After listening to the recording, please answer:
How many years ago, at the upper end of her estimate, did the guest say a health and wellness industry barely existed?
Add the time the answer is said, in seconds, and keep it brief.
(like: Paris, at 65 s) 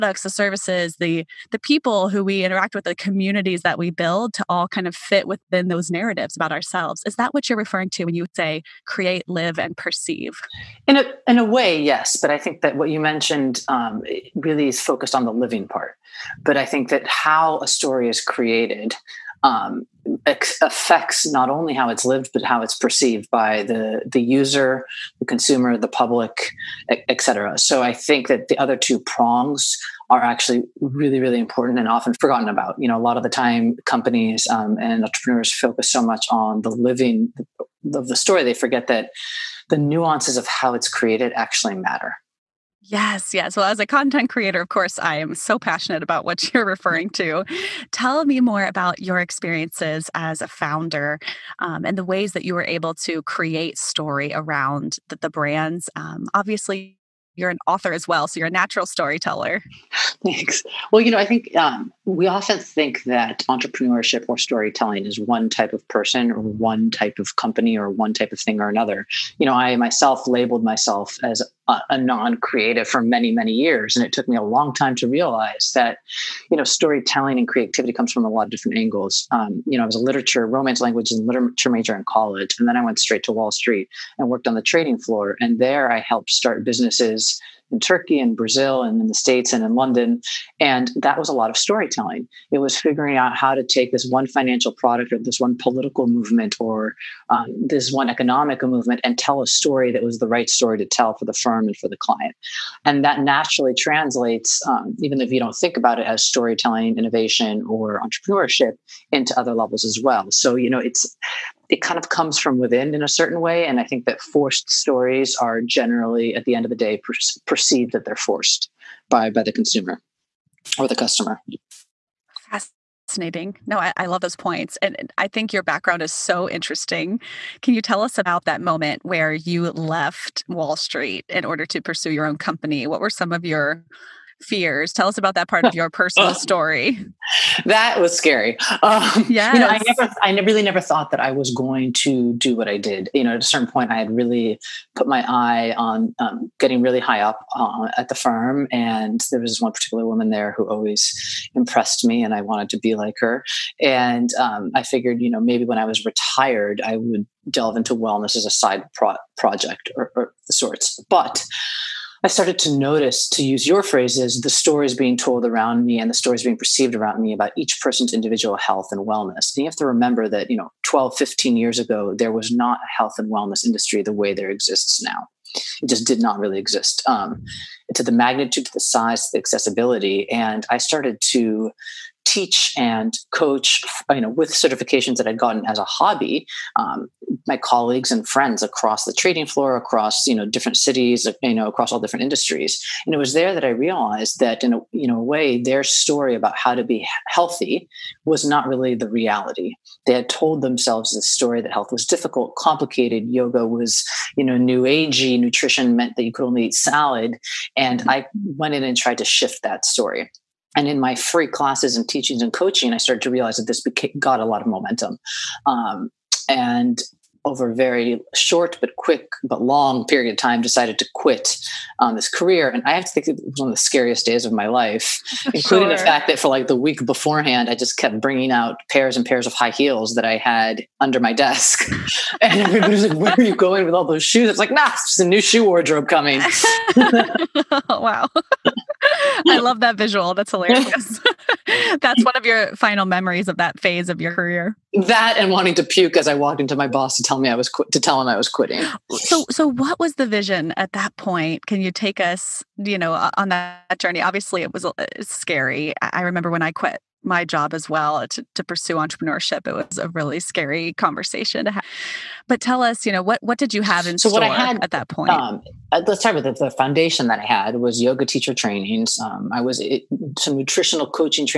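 15, at 171 s.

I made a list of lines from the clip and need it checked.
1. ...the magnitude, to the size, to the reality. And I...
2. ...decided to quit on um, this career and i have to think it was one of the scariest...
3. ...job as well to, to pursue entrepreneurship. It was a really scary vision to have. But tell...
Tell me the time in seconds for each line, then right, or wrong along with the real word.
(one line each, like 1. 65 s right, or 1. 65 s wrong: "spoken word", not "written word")
1. 178 s wrong: "accessibility", not "reality"
2. 220 s right
3. 257 s wrong: "conversation", not "vision".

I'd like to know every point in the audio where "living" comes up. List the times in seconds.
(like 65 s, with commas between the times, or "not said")
15 s, 36 s.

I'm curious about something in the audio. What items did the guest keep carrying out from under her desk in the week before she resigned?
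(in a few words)
High heels.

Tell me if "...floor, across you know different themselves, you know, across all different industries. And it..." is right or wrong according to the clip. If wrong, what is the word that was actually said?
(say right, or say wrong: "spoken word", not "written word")
wrong: "cities", not "themselves".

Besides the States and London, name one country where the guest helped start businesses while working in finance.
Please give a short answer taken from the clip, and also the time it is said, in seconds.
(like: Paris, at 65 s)
Turkey, at 87 s.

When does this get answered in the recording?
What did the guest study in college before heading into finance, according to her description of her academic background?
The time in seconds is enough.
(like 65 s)
80 s.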